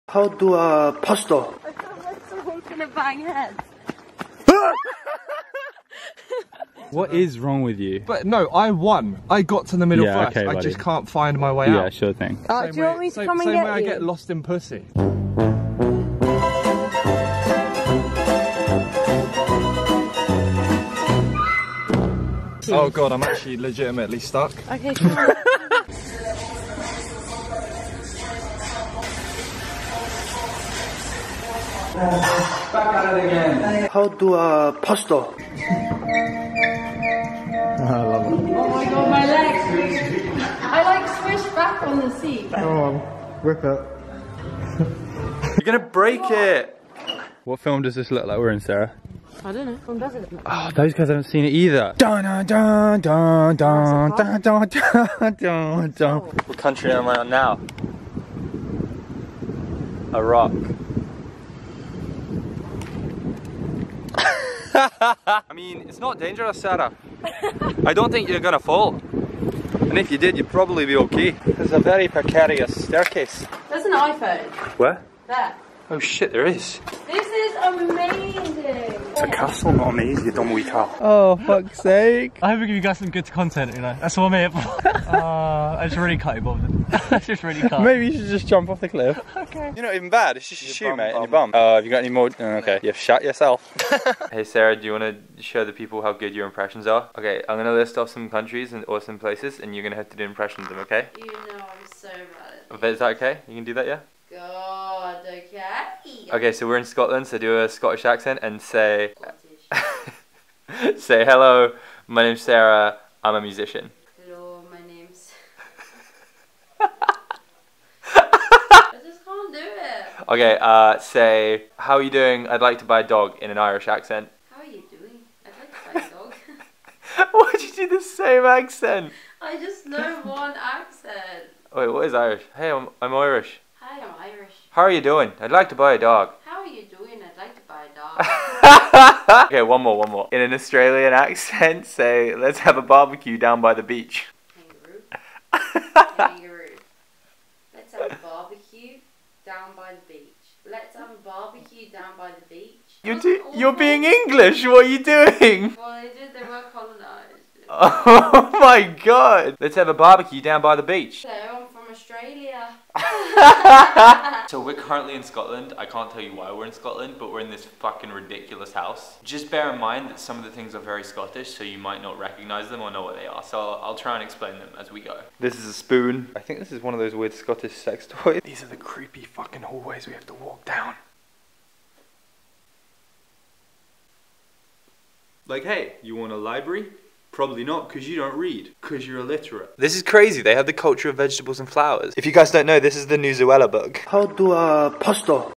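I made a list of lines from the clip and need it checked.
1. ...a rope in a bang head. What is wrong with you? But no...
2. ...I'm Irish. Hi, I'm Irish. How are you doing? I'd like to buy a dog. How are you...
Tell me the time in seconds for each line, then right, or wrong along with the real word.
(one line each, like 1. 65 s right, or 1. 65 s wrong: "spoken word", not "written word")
1. 2 s right
2. 133 s right.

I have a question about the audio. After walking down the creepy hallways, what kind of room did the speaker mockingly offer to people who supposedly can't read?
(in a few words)
Library.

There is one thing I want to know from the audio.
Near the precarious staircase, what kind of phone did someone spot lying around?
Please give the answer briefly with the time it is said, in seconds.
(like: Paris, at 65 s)
iPhone, at 73 s.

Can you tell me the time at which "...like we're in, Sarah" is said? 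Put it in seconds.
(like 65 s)
48 s.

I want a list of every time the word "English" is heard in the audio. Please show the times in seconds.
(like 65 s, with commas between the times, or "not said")
154 s.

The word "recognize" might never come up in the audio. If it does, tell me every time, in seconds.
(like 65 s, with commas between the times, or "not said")
172 s.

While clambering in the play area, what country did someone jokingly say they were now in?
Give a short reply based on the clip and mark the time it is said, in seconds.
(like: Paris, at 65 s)
Iraq, at 60 s.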